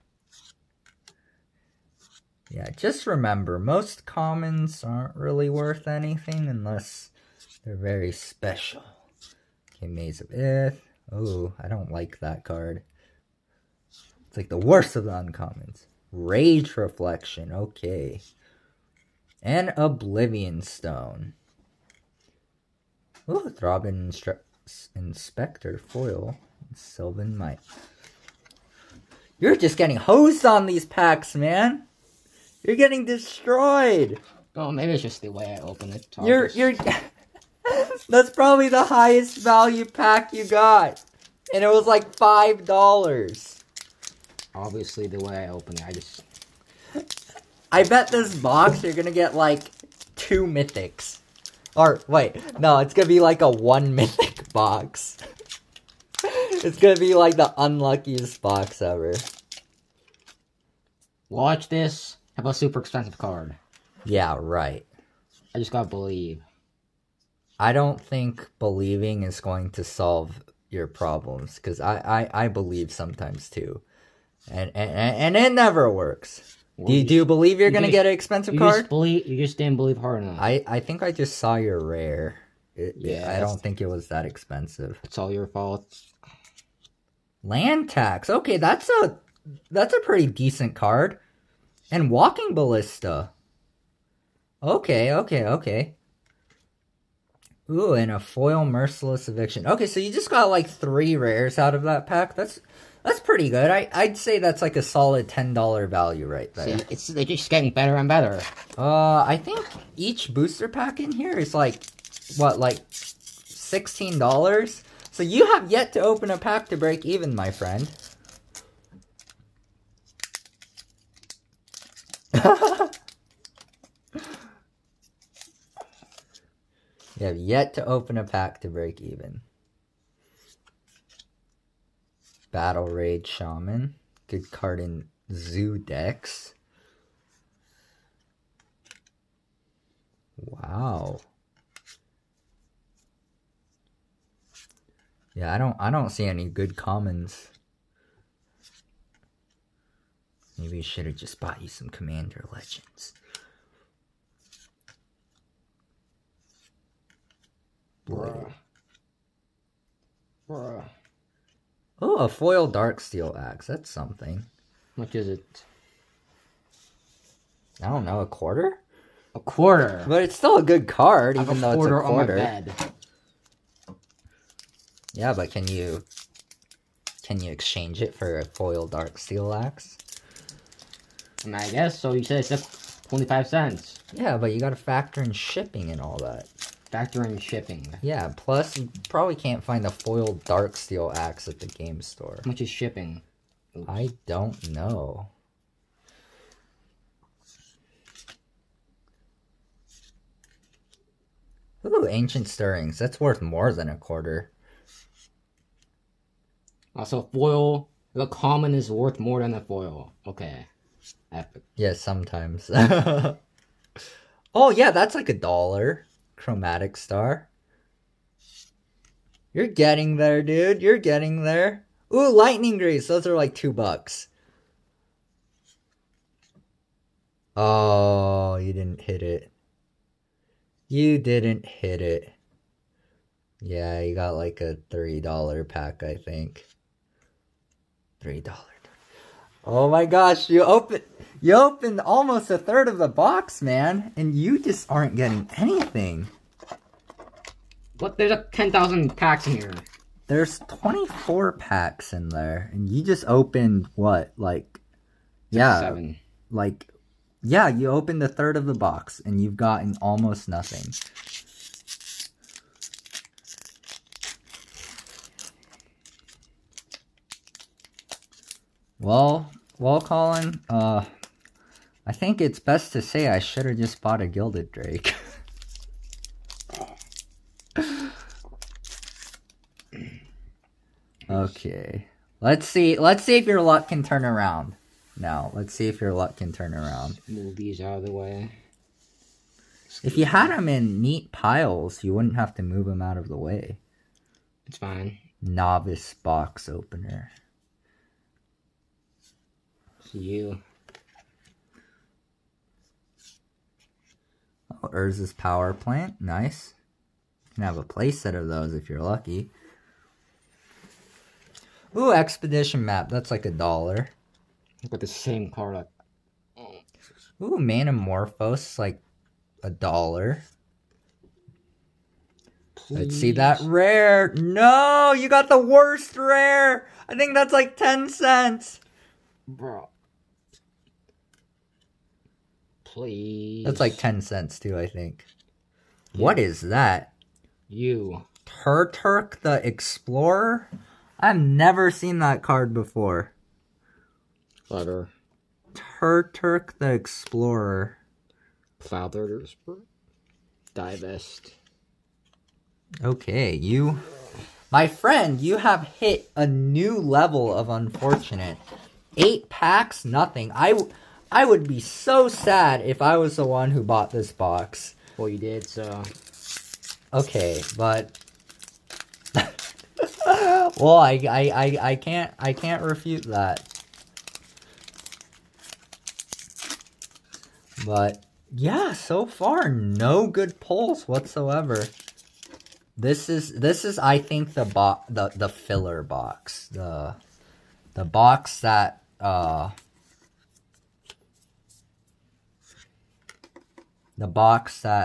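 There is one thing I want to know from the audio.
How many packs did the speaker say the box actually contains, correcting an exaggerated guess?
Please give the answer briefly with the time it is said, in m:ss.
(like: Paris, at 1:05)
24, at 4:10.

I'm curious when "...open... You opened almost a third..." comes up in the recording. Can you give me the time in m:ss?
4:00.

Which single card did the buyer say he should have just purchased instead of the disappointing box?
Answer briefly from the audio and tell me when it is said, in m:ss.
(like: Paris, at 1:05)
Gilded Drake, at 4:34.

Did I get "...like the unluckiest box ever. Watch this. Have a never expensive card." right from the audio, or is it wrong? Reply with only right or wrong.
wrong.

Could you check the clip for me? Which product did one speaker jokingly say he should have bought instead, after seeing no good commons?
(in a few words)
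Commander Legends.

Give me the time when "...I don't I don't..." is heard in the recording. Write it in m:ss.
2:25.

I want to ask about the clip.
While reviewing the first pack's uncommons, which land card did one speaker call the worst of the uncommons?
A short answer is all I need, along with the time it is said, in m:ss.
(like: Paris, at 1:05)
Maze of Ith, at 0:09.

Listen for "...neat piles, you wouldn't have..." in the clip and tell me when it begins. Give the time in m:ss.
4:51.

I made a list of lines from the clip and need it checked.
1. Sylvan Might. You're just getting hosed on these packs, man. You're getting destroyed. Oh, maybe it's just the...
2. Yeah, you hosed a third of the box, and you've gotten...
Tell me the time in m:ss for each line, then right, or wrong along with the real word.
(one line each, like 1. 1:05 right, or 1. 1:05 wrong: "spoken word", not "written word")
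1. 0:26 right
2. 4:17 wrong: "opened", not "hosed".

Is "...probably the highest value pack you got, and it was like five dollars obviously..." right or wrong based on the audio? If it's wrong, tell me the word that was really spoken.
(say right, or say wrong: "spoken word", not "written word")
right.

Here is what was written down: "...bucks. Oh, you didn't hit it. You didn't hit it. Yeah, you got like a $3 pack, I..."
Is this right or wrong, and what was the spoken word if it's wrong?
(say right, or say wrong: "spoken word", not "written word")
right.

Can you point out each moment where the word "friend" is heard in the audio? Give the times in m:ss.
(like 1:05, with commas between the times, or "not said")
1:57, 5:54.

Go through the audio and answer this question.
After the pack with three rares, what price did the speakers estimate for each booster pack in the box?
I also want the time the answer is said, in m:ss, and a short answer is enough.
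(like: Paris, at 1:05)
$16, at 1:52.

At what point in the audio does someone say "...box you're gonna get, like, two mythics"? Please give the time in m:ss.
0:48.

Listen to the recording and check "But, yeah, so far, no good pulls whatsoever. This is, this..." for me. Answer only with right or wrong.
right.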